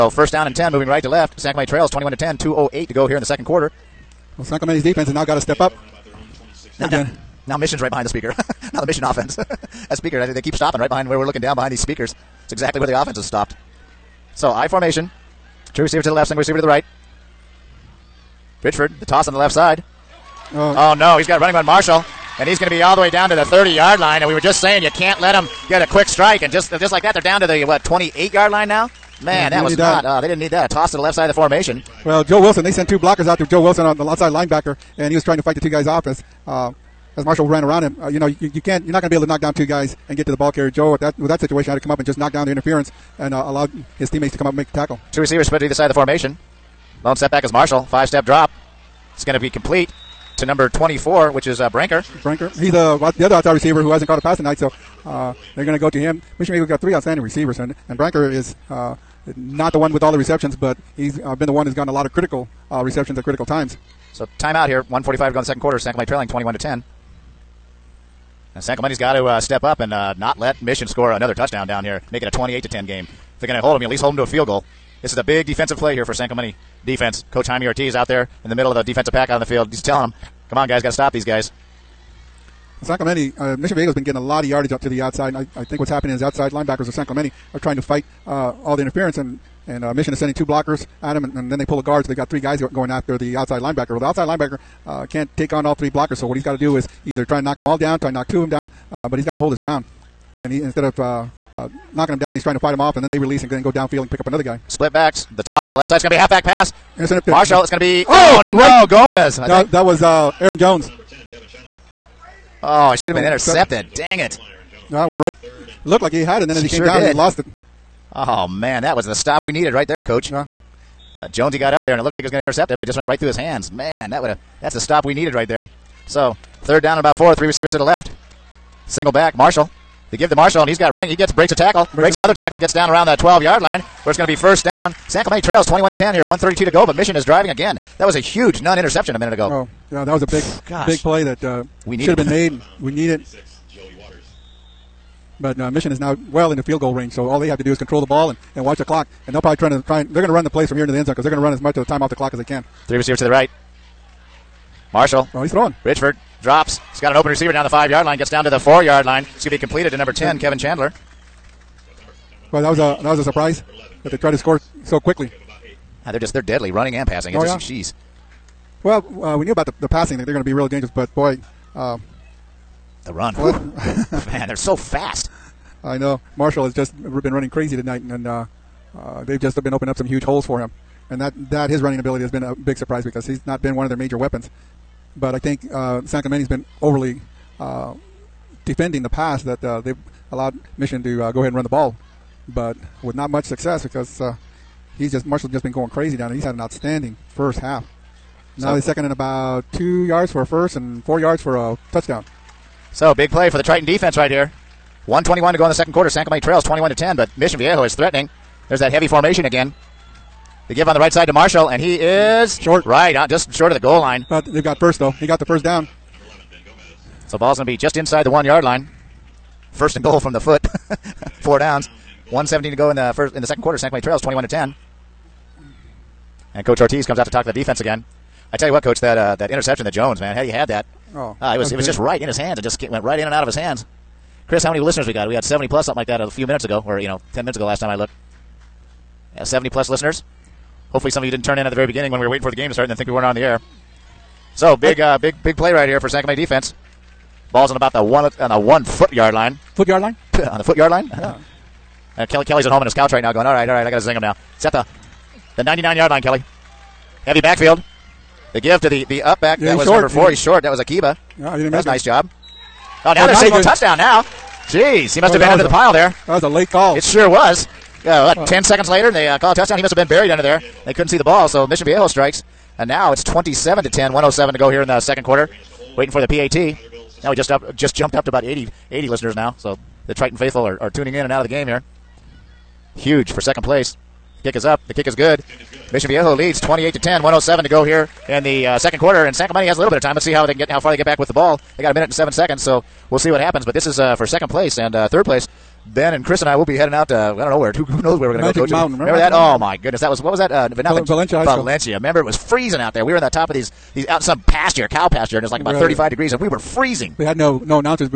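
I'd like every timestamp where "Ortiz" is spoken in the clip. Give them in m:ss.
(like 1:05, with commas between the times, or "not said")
1:17, 3:46.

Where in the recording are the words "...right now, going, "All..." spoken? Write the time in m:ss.
4:13.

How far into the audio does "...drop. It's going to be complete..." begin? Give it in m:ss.
0:48.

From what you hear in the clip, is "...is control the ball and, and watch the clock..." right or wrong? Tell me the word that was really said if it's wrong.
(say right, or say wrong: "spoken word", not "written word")
right.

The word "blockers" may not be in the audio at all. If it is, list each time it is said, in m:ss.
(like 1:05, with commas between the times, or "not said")
0:32, 1:30, 1:35.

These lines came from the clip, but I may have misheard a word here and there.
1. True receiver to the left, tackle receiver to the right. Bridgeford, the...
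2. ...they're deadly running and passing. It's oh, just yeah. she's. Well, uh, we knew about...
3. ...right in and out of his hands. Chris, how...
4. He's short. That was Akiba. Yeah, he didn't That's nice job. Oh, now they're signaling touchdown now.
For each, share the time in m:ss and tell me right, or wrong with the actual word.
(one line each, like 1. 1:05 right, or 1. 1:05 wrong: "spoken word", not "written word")
1. 0:15 wrong: "single", not "tackle"
2. 2:46 right
3. 3:53 right
4. 4:20 right.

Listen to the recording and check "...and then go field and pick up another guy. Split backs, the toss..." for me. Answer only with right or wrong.
wrong.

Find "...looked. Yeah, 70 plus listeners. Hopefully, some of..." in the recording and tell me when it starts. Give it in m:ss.
3:57.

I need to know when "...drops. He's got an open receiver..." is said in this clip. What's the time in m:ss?
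2:36.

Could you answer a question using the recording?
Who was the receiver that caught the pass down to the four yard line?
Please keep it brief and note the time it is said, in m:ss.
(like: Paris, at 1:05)
Kevin Chandler, at 2:40.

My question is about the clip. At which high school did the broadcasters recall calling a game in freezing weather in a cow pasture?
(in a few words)
Valencia High School.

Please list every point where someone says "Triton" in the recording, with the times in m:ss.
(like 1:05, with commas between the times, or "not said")
3:23, 4:40.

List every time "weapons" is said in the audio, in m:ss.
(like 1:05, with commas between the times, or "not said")
3:04.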